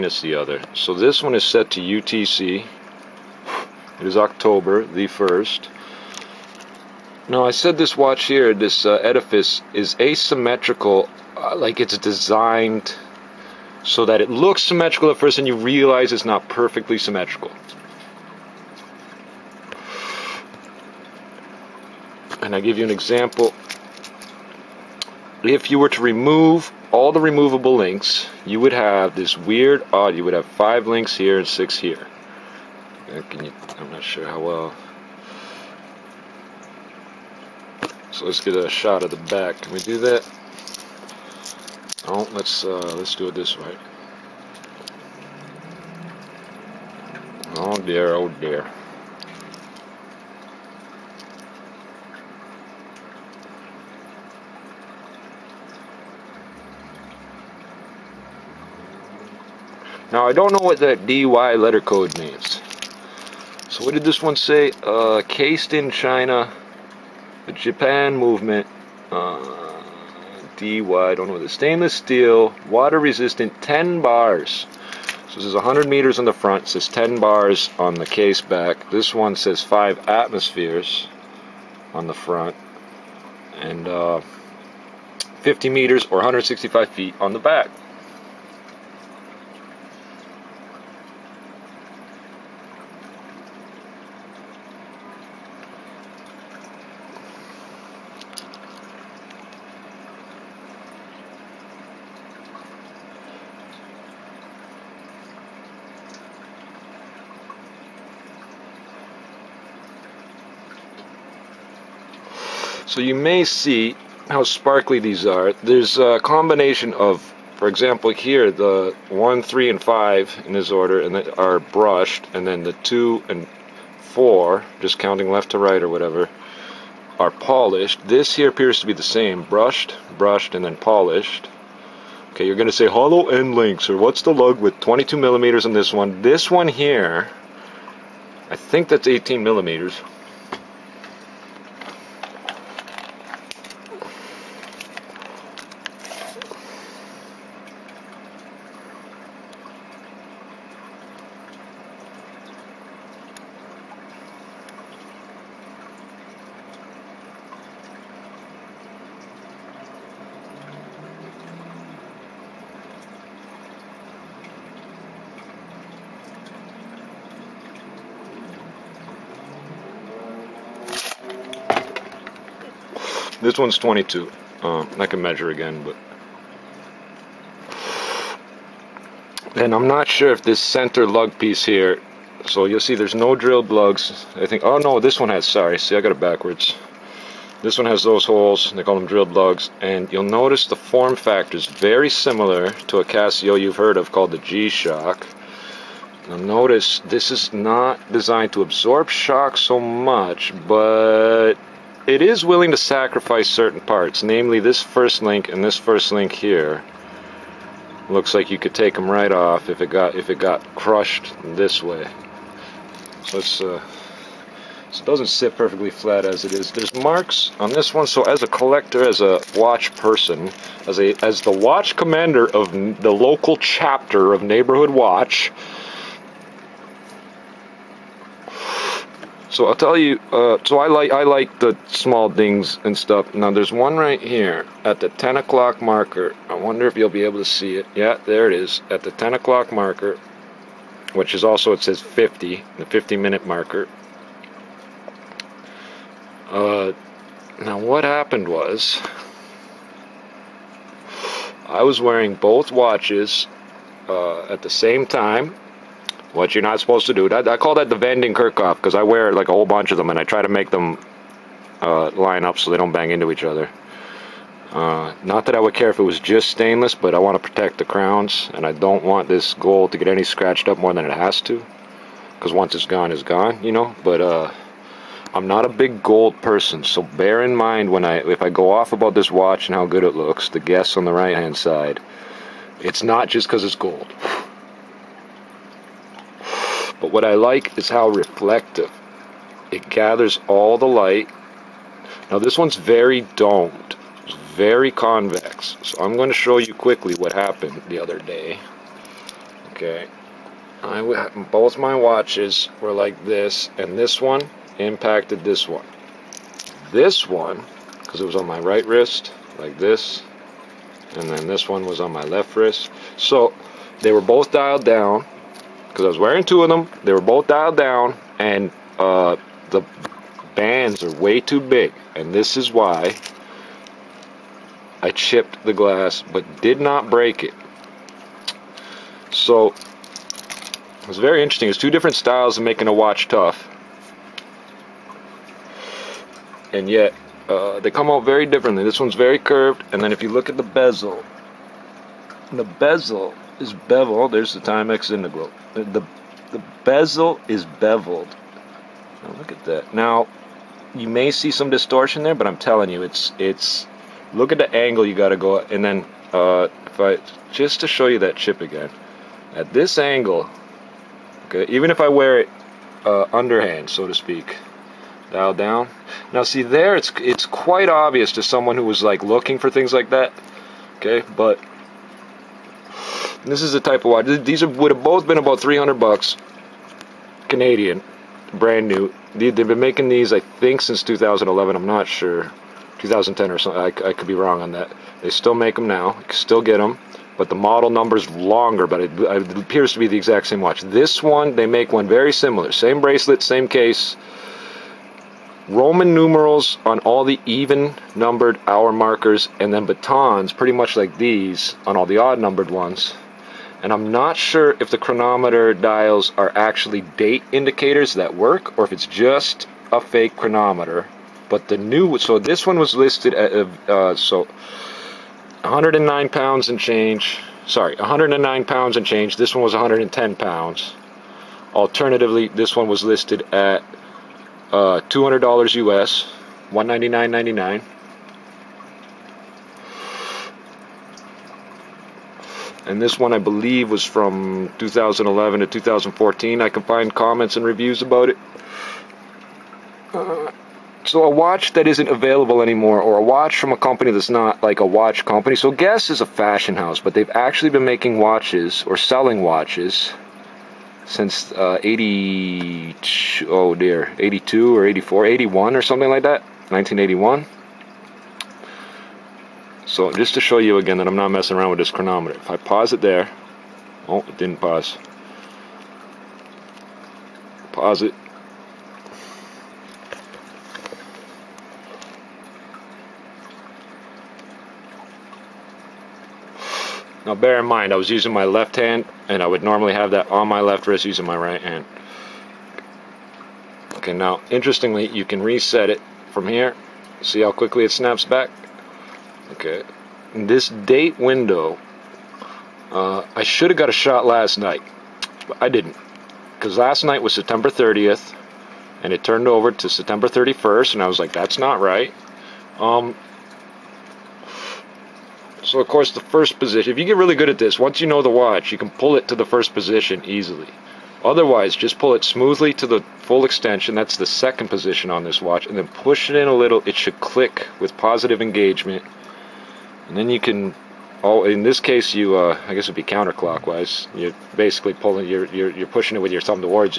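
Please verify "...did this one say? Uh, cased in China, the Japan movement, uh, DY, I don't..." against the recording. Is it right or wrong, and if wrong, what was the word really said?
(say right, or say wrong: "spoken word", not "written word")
right.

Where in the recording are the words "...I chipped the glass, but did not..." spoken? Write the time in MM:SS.
05:25.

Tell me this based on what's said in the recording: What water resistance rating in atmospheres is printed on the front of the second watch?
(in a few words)
5 atmospheres.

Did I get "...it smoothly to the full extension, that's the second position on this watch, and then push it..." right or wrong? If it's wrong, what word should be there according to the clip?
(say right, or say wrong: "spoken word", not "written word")
right.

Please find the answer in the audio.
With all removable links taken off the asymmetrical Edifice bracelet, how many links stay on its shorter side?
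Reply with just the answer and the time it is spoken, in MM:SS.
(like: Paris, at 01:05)
5, at 00:30.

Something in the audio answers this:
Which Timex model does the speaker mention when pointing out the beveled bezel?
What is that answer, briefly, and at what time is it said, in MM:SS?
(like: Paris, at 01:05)
Timex Integral, at 05:44.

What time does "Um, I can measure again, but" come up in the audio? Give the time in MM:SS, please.
02:54.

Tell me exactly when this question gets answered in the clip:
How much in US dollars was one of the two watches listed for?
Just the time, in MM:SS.
07:06.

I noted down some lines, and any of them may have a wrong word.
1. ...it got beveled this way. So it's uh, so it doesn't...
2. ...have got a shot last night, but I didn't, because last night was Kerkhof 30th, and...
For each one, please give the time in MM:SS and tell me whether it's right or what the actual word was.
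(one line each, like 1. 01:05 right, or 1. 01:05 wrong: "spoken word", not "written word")
1. 03:30 wrong: "crushed", not "beveled"
2. 08:13 wrong: "September", not "Kerkhof".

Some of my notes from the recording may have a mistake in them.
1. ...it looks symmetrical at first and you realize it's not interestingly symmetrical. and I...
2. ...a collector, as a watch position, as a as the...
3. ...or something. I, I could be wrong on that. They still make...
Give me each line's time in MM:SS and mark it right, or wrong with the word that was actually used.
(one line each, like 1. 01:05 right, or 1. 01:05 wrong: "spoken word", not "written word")
1. 00:14 wrong: "perfectly", not "interestingly"
2. 03:38 wrong: "person", not "position"
3. 06:23 right.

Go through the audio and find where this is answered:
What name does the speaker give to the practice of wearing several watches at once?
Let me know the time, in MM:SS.
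04:17.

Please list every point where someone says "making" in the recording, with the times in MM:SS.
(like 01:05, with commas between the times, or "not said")
05:32, 06:19, 07:27.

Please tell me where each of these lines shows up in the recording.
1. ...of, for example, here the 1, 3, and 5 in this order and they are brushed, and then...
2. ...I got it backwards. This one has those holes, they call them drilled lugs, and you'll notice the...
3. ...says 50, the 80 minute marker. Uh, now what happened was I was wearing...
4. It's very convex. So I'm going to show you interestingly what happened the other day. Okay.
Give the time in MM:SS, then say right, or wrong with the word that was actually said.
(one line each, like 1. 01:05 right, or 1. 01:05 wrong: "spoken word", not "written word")
1. 01:56 right
2. 03:05 right
3. 04:01 wrong: "50", not "80"
4. 04:54 wrong: "quickly", not "interestingly".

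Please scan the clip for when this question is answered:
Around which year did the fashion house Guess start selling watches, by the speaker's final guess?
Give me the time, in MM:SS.
07:36.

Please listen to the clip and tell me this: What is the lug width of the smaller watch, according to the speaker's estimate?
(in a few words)
18 millimeters.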